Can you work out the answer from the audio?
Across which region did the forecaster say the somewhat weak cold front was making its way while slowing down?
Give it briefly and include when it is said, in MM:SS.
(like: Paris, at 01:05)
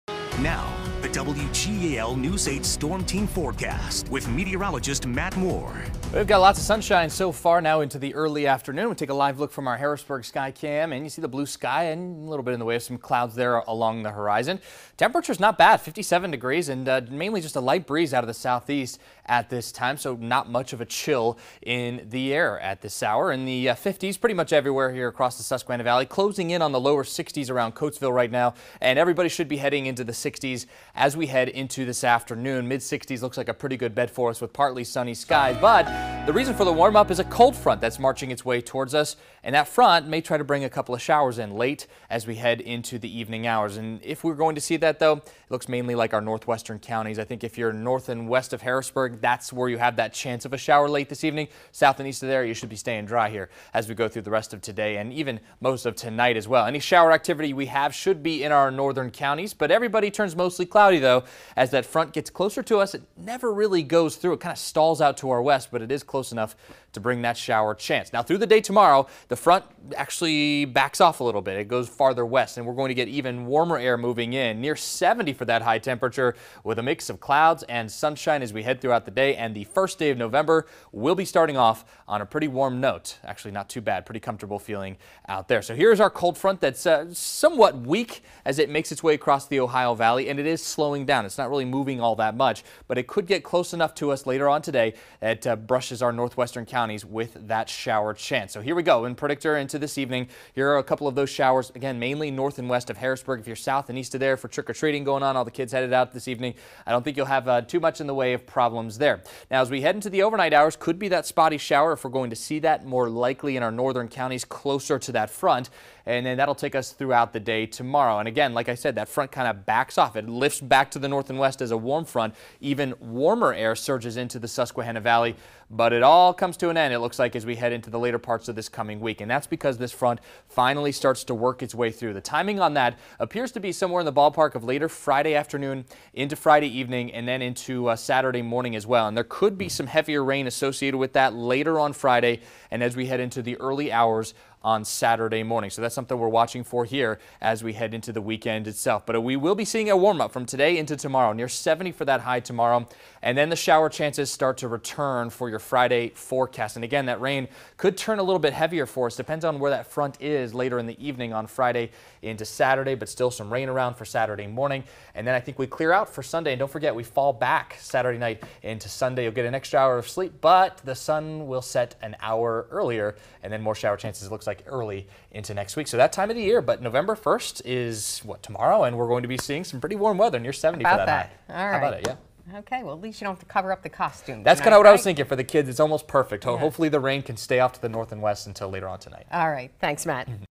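Ohio Valley, at 01:29.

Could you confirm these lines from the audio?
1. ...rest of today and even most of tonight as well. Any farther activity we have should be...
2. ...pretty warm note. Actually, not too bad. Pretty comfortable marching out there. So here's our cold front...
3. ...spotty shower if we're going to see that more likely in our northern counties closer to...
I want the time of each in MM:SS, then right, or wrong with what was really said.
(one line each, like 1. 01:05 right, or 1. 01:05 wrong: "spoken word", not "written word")
1. 00:54 wrong: "shower", not "farther"
2. 01:22 wrong: "feeling", not "marching"
3. 01:51 right.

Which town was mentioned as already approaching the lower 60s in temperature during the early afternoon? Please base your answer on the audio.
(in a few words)
Coatesville.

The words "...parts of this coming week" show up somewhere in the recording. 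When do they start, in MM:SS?
02:08.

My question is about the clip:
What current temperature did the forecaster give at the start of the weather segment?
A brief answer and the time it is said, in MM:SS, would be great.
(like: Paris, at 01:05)
57 degrees, at 00:15.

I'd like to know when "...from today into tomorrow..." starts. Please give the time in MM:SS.
02:30.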